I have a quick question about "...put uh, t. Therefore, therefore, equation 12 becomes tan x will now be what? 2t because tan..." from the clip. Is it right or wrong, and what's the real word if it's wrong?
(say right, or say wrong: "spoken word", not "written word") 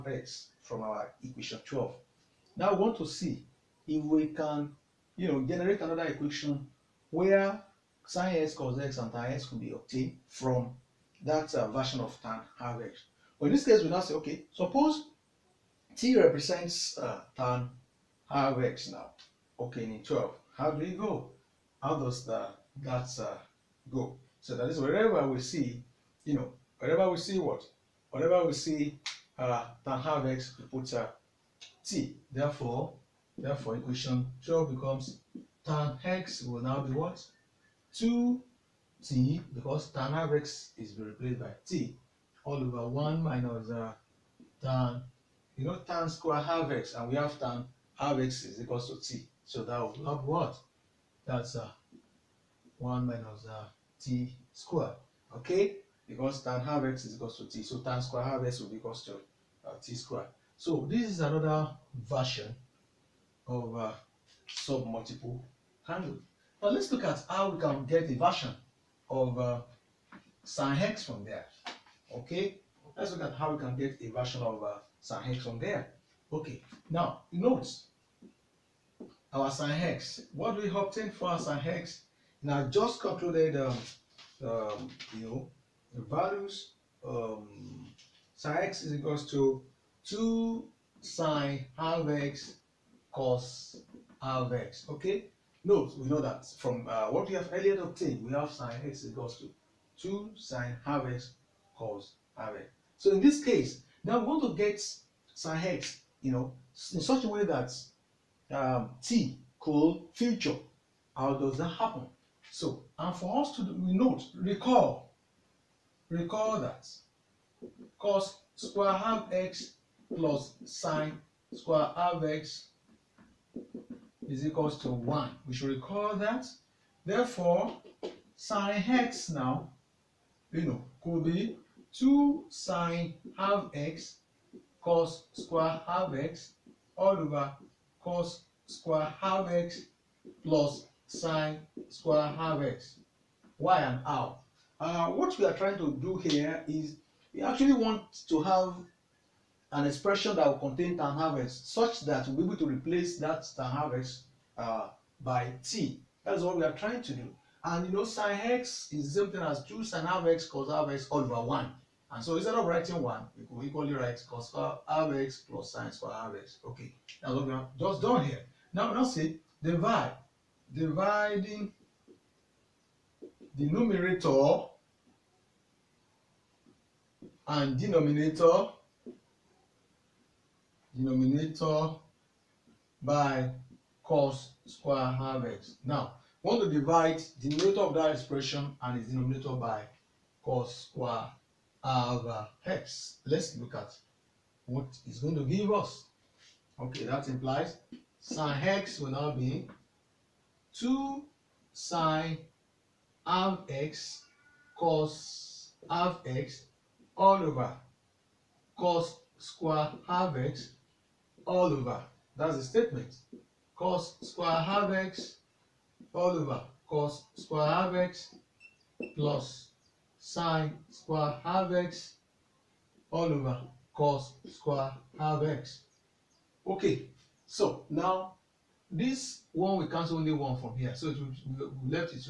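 right.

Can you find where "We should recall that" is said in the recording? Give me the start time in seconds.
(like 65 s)
125 s.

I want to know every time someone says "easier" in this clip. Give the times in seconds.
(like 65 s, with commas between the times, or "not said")
not said.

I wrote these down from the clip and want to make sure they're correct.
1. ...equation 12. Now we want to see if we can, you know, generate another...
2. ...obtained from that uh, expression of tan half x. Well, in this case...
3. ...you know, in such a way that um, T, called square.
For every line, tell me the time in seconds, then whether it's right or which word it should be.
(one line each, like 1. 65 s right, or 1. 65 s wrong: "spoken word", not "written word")
1. 1 s right
2. 9 s wrong: "version", not "expression"
3. 106 s wrong: "future", not "square".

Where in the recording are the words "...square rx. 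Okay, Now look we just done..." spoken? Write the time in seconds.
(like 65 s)
165 s.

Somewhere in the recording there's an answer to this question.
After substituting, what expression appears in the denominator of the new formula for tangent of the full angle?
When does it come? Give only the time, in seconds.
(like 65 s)
52 s.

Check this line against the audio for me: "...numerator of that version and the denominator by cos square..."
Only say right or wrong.
wrong.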